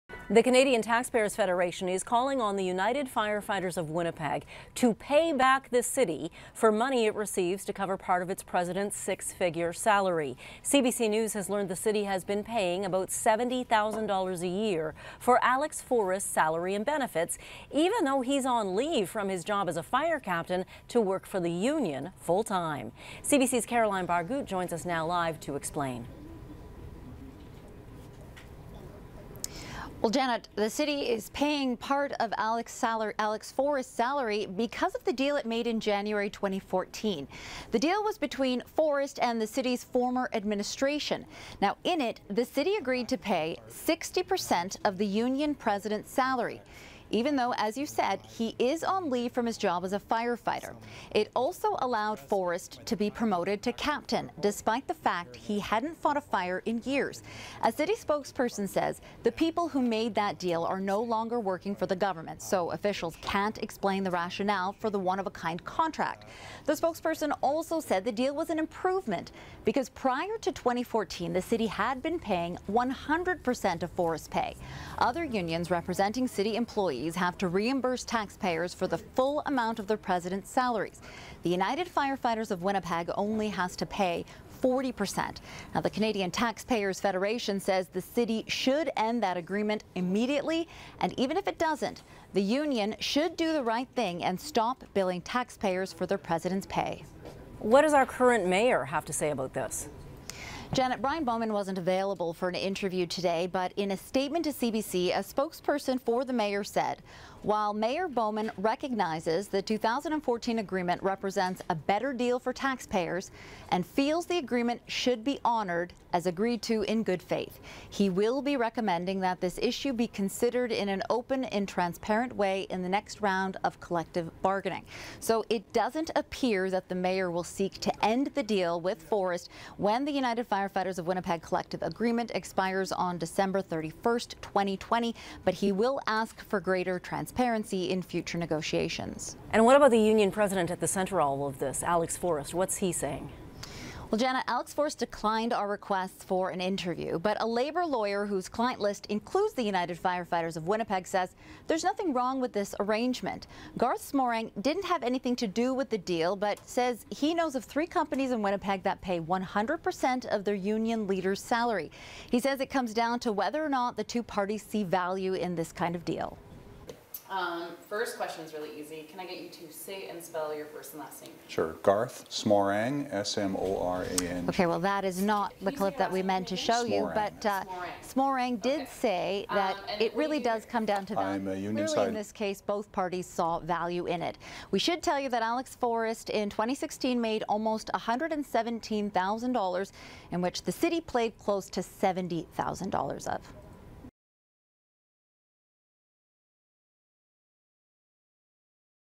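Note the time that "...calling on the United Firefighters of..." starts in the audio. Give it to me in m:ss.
0:02.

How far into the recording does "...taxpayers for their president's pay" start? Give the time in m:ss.
1:35.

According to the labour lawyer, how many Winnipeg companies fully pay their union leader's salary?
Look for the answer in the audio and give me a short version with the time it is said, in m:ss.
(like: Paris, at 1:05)
3, at 2:37.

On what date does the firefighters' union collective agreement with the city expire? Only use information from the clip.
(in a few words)
December 31st, 2020.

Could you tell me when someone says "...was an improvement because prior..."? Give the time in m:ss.
1:08.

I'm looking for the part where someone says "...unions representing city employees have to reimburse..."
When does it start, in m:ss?
1:15.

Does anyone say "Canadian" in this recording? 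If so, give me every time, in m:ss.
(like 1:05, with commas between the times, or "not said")
0:00, 1:25.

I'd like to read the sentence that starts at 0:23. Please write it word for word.
CBC's Caroline Barghout joins us now live to explain.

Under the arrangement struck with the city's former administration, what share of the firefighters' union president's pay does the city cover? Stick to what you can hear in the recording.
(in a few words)
60%.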